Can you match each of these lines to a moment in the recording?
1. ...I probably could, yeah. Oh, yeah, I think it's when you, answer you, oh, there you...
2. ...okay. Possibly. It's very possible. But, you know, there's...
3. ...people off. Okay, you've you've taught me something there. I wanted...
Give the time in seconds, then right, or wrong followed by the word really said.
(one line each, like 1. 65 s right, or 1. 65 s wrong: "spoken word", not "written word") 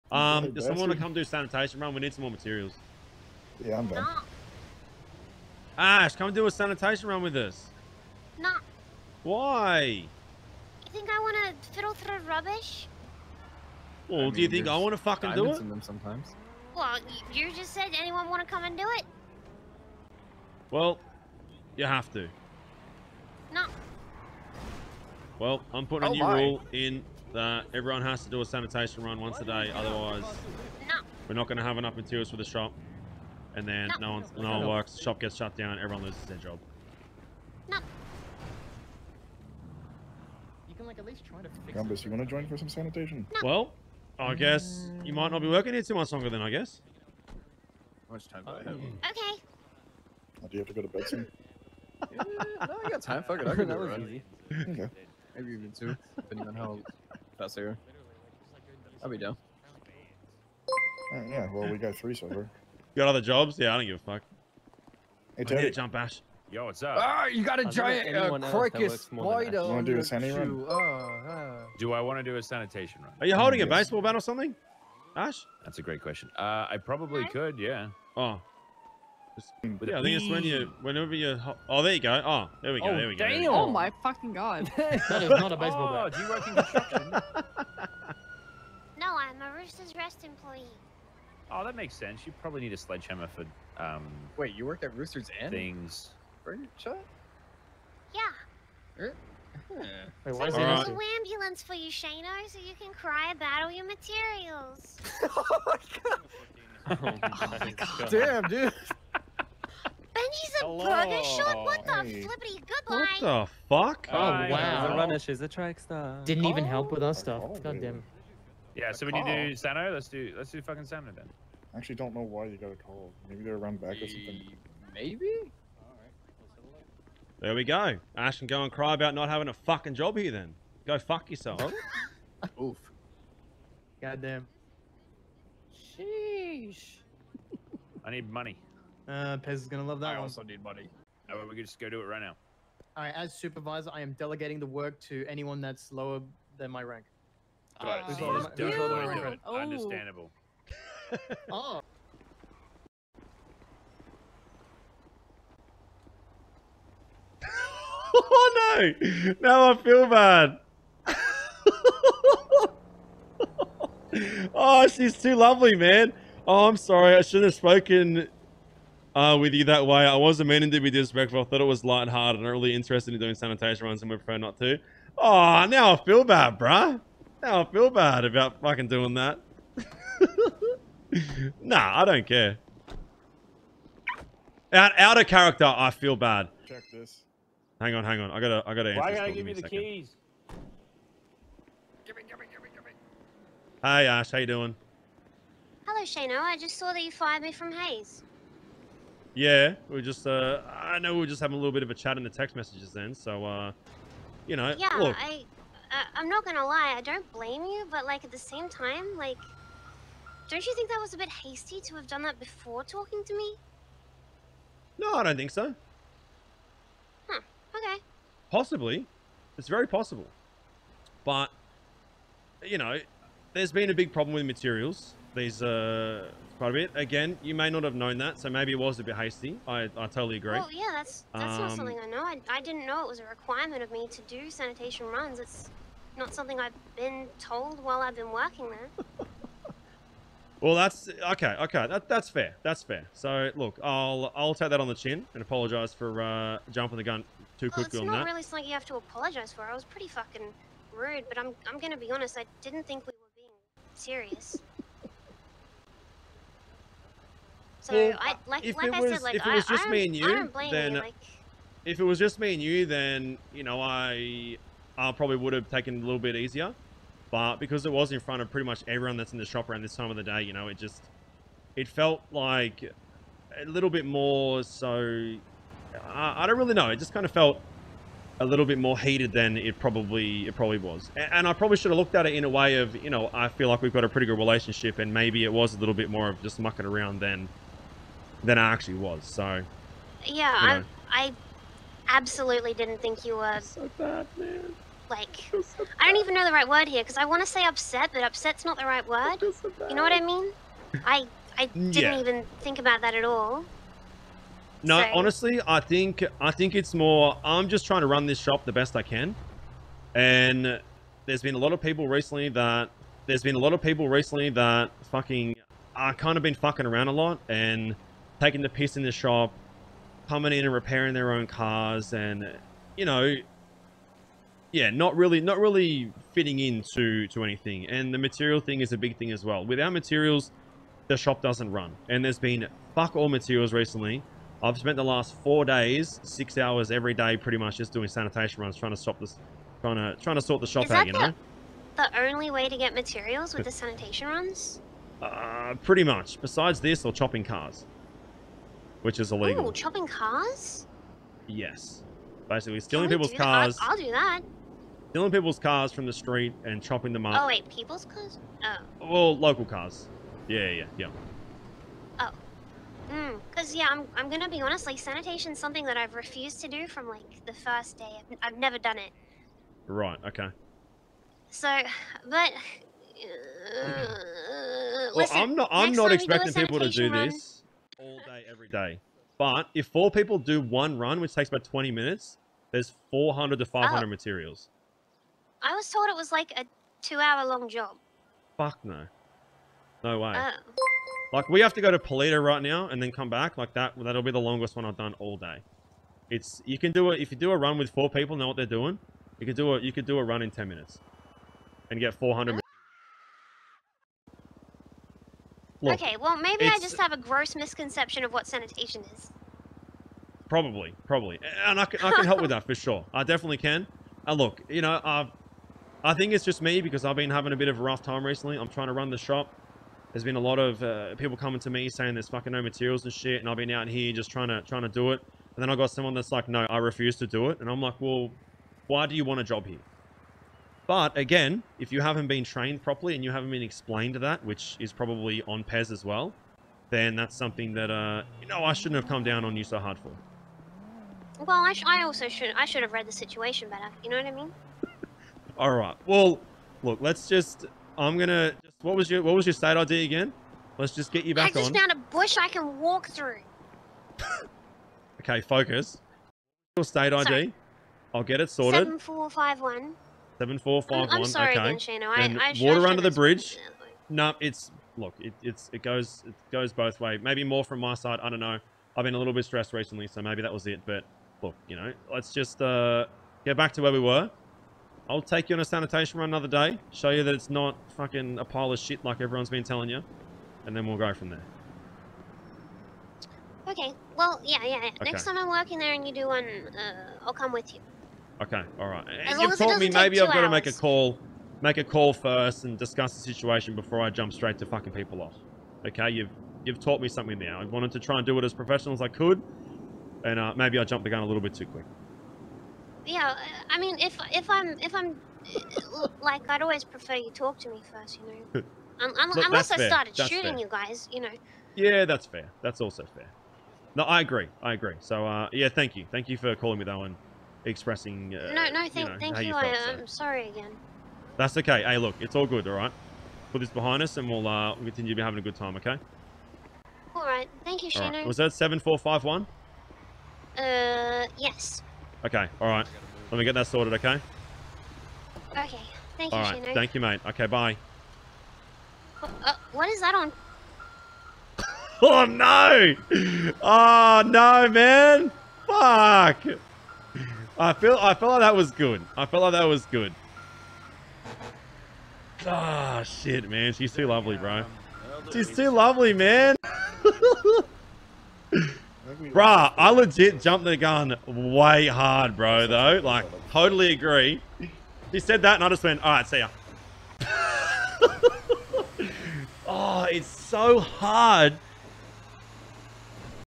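1. 76 s wrong: "whenever", not "answer"
2. 217 s right
3. 494 s right.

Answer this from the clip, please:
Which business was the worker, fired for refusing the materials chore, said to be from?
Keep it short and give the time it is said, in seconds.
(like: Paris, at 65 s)
Hayes, at 197 s.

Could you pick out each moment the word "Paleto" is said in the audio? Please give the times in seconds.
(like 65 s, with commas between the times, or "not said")
391 s.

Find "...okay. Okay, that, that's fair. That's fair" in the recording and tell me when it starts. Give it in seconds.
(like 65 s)
241 s.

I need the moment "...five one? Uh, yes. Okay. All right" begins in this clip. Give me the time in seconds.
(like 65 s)
528 s.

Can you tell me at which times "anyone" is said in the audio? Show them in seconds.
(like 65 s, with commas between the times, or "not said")
17 s, 145 s.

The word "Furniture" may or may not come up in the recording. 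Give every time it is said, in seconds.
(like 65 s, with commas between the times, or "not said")
96 s.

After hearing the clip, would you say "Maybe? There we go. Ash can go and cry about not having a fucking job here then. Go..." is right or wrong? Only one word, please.
right.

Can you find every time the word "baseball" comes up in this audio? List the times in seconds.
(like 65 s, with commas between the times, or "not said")
73 s, 85 s.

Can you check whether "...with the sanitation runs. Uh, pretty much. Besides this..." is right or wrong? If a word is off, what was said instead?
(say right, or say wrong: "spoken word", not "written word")
right.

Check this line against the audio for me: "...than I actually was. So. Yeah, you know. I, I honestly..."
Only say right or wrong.
wrong.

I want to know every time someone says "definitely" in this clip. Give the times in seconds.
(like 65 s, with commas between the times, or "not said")
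413 s.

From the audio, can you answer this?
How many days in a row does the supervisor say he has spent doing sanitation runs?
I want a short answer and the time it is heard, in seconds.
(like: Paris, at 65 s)
4, at 335 s.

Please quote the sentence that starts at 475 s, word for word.
I'll take you on a sanitation run another day.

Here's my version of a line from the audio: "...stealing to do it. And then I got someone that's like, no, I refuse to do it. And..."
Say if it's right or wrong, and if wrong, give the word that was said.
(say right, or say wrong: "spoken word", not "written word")
wrong: "trying", not "stealing".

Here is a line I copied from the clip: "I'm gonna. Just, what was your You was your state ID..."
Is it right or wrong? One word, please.
wrong.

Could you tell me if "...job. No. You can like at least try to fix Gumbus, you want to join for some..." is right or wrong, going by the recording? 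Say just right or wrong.
right.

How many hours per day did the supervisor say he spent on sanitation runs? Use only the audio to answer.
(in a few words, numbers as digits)
6.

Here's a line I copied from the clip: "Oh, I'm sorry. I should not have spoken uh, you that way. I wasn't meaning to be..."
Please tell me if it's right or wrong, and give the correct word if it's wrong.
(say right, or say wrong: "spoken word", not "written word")
right.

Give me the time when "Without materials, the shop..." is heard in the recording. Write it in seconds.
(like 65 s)
329 s.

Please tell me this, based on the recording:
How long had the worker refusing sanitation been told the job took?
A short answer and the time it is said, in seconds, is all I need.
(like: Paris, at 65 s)
2 hours, at 387 s.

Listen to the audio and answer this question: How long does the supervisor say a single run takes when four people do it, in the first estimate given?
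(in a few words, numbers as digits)
20 minutes.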